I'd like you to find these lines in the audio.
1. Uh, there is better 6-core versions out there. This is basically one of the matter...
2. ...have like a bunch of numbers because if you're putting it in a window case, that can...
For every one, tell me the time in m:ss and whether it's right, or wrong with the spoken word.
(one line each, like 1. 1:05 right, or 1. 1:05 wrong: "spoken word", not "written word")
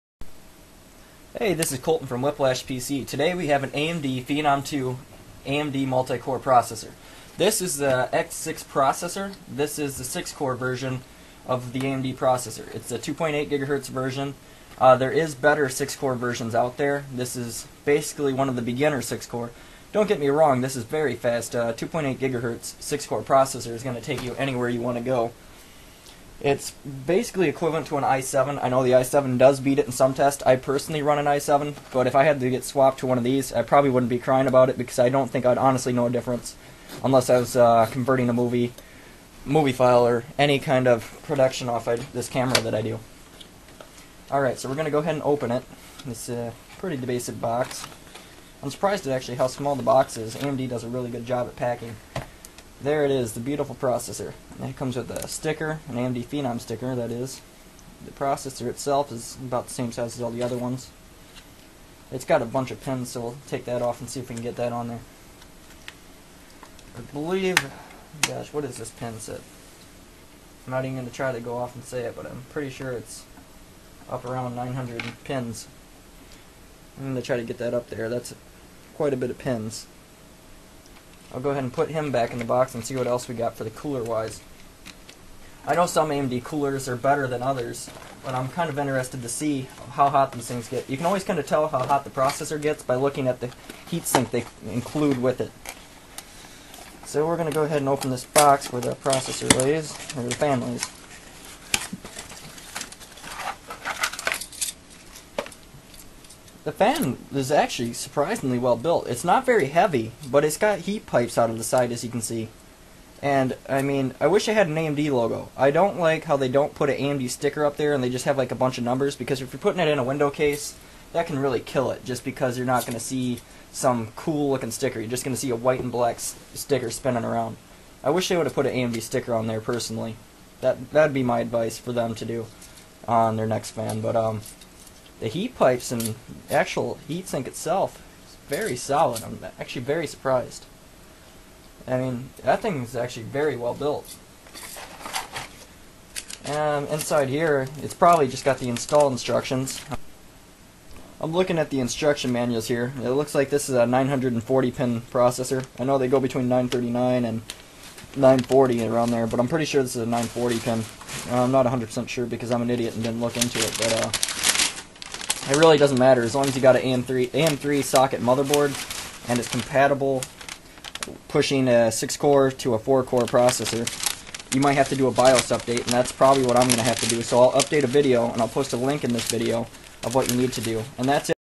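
1. 0:14 wrong: "beginner", not "matter"
2. 1:58 right.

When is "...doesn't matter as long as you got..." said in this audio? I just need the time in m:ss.
2:45.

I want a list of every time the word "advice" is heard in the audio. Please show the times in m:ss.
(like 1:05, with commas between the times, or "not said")
2:11.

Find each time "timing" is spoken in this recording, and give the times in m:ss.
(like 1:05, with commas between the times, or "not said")
not said.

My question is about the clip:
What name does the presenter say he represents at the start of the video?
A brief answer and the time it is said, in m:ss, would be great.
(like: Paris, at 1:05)
Whiplash PC, at 0:02.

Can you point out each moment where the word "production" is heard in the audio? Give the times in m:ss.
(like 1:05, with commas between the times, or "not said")
0:41.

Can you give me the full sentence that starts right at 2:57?
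So I'll update a video, and I'll post a link in this video of what you need to do.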